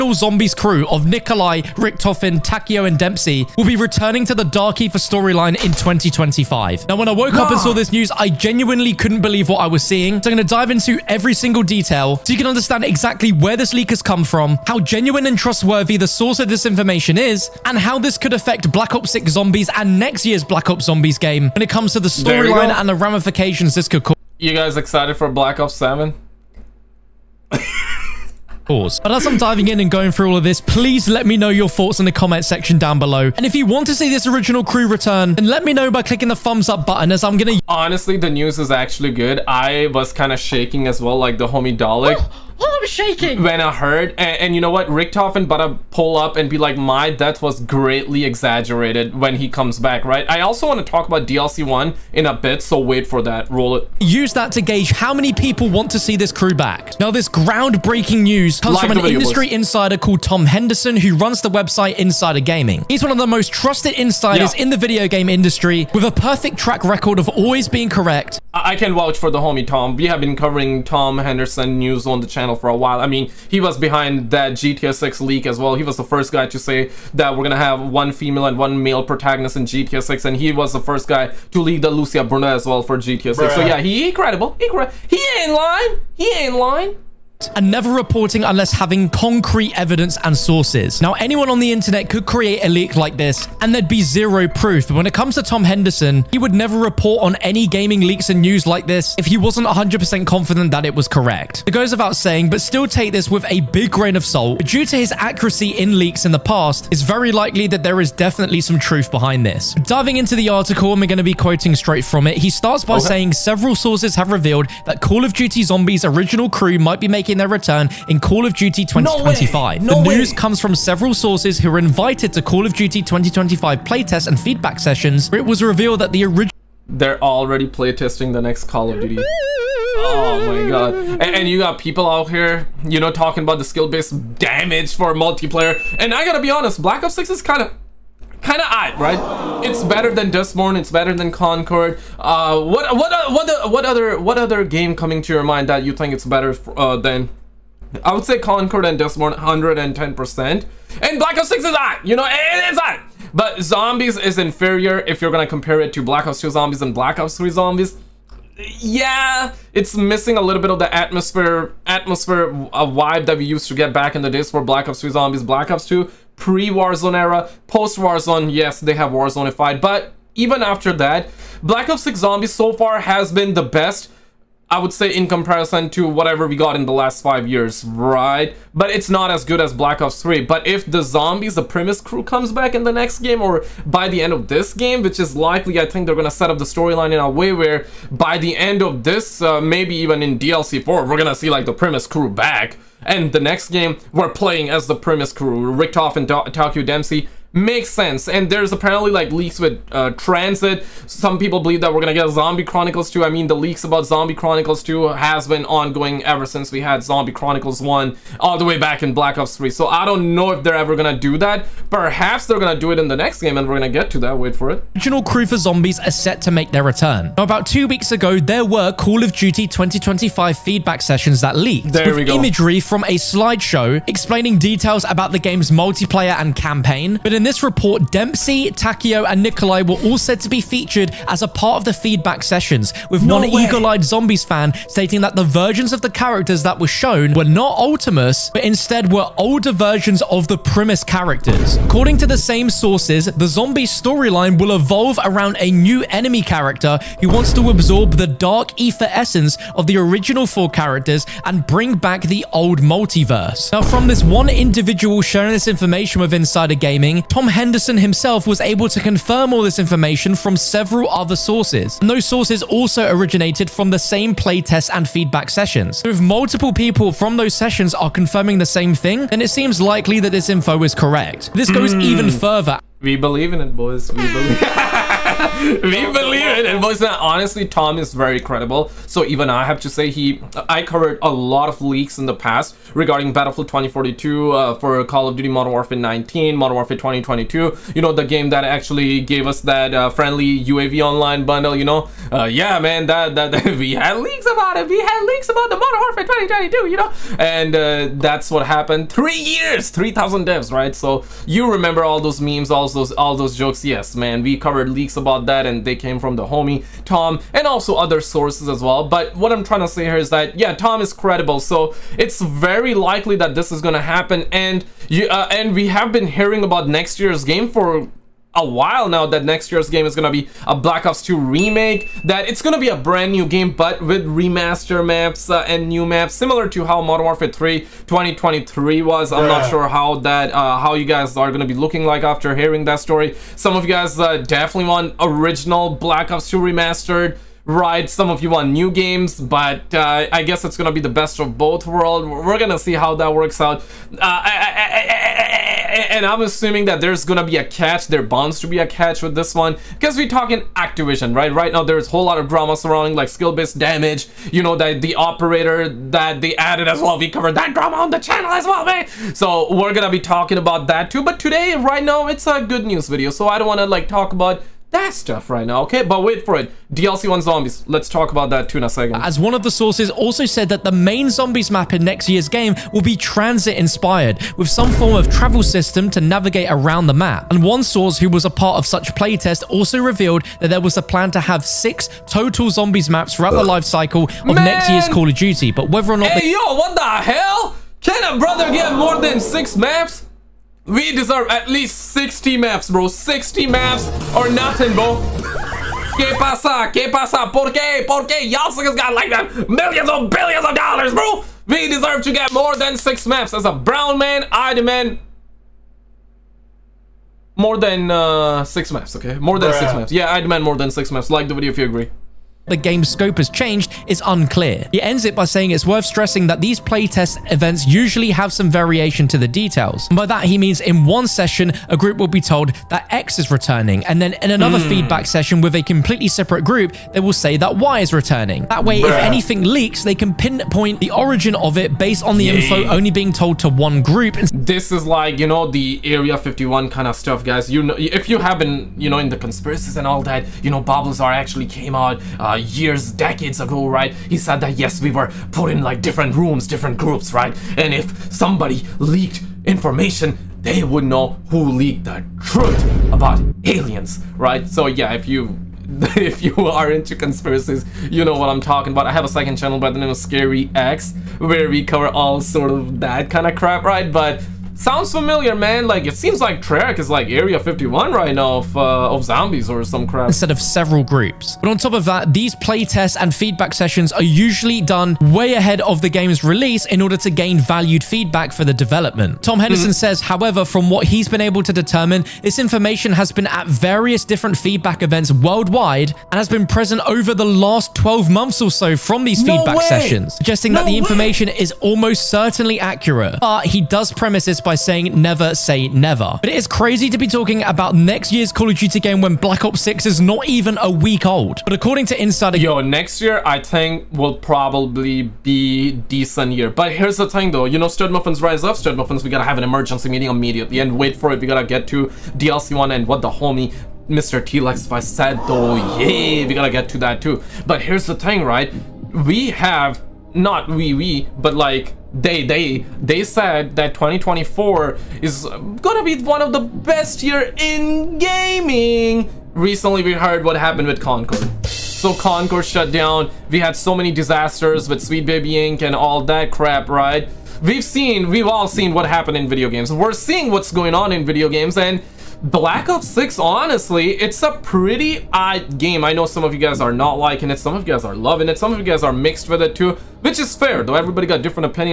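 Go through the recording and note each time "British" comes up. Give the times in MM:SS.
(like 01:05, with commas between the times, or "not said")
not said.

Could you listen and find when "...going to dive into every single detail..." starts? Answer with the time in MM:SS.
00:10.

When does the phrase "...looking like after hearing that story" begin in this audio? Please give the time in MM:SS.
05:31.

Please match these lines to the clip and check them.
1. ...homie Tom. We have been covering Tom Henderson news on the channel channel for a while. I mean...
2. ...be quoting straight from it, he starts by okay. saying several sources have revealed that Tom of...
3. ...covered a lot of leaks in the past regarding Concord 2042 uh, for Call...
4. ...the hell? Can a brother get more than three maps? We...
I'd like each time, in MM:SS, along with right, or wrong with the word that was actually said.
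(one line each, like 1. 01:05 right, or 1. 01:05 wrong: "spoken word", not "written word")
1. 01:09 right
2. 01:51 wrong: "Call", not "Tom"
3. 04:40 wrong: "Battlefield", not "Concord"
4. 06:26 wrong: "six", not "three".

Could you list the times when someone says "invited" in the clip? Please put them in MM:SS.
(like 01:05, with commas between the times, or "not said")
02:01.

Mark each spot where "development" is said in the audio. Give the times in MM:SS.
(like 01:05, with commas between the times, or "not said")
07:58.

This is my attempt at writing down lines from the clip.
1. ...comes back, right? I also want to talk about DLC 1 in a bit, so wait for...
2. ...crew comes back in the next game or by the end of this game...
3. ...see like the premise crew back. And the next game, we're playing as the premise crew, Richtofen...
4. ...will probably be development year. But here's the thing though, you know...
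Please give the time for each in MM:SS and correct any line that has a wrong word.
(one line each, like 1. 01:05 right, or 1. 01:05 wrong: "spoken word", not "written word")
1. 00:49 right
2. 03:02 right
3. 03:11 right
4. 08:24 wrong: "decent", not "development".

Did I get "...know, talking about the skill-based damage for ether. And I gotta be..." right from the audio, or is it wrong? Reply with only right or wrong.
wrong.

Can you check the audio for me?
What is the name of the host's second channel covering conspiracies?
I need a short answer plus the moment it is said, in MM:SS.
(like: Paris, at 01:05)
Scary Axe, at 07:40.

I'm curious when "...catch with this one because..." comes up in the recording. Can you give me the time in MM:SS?
05:48.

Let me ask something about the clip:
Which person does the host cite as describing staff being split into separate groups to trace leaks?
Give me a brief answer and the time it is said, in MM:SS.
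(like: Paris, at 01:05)
Bob Lazar, at 07:20.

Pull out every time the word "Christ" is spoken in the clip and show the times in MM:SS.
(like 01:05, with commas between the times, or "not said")
not said.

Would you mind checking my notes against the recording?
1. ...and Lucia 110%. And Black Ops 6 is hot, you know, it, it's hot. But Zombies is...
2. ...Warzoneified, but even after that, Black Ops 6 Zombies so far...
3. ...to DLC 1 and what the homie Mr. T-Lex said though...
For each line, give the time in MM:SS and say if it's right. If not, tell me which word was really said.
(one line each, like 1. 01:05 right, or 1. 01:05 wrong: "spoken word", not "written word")
1. 02:28 wrong: "Dustborn", not "Lucia"
2. 02:49 right
3. 08:31 right.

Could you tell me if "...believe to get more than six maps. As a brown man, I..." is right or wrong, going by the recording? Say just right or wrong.
wrong.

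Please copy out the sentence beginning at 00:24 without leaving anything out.
You guys excited for Black Ops 7?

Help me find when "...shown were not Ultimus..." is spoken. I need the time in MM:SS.
03:56.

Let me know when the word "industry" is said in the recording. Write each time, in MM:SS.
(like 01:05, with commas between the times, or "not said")
00:59, 01:05.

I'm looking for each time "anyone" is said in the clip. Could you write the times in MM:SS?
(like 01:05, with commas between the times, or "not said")
01:31.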